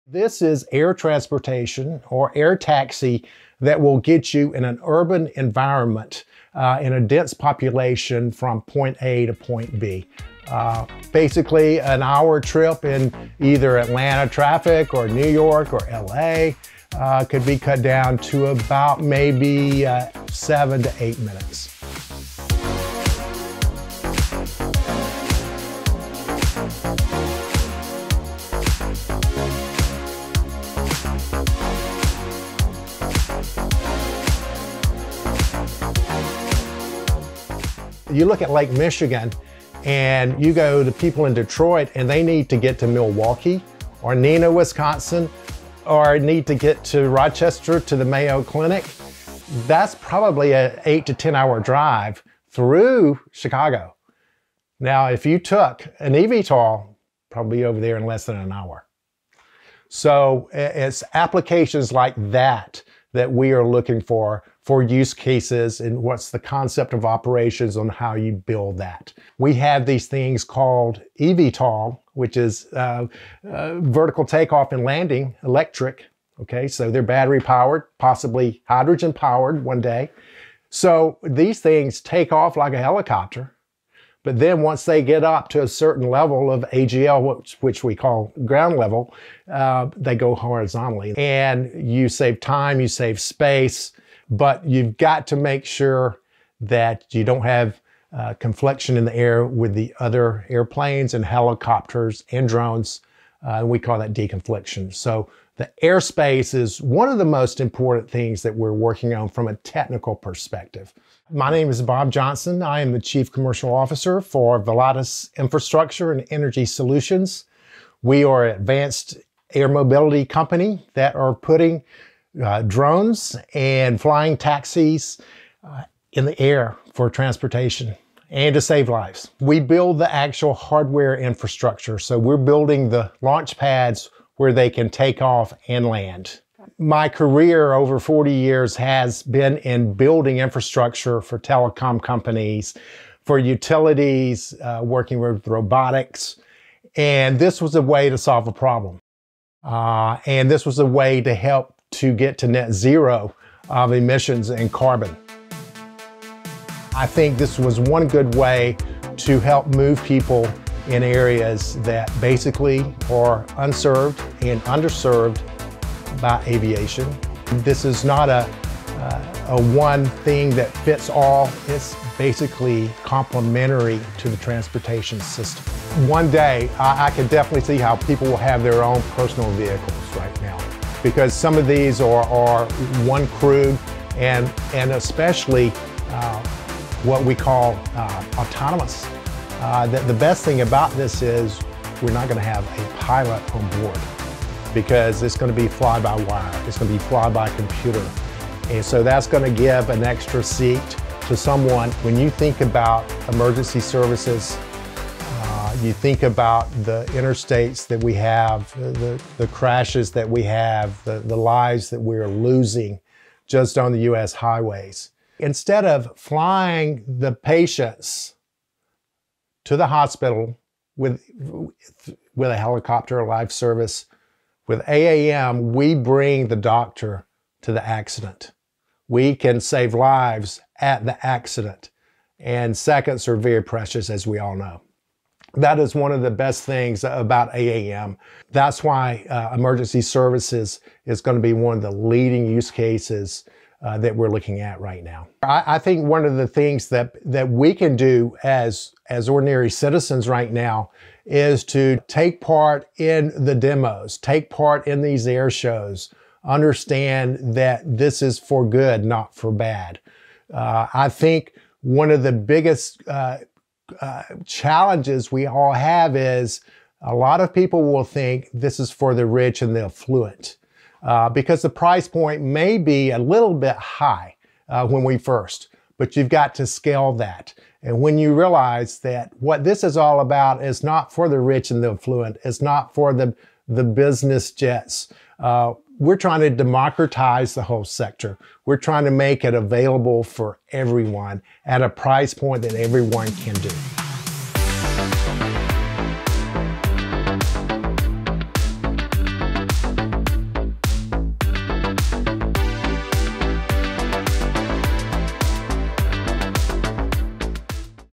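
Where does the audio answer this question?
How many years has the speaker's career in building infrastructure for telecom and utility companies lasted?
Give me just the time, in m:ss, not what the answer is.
2:17.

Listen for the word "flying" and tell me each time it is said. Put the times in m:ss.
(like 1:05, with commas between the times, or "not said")
2:03, 3:36.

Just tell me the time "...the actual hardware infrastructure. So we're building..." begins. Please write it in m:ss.
2:09.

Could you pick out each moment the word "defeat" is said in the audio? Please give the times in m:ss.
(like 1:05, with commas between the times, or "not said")
not said.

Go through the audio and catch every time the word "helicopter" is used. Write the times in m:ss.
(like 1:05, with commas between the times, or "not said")
1:22, 1:41, 3:42.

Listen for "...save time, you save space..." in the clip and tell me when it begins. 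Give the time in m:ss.
1:32.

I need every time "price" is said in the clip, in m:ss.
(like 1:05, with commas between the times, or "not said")
4:31, 4:51.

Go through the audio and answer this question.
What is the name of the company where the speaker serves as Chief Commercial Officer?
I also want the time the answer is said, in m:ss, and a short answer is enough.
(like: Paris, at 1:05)
Volatus Infrastructure and Energy Solutions, at 1:54.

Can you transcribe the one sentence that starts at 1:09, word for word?
We have these things called eVTOL, which is uh, uh, vertical takeoff and landing, electric.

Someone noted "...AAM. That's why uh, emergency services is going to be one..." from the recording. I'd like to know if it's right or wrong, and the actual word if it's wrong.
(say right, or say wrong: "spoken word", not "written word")
right.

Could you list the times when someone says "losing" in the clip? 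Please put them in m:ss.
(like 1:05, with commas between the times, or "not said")
3:32.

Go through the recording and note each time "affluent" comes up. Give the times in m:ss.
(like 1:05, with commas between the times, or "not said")
4:29, 4:41.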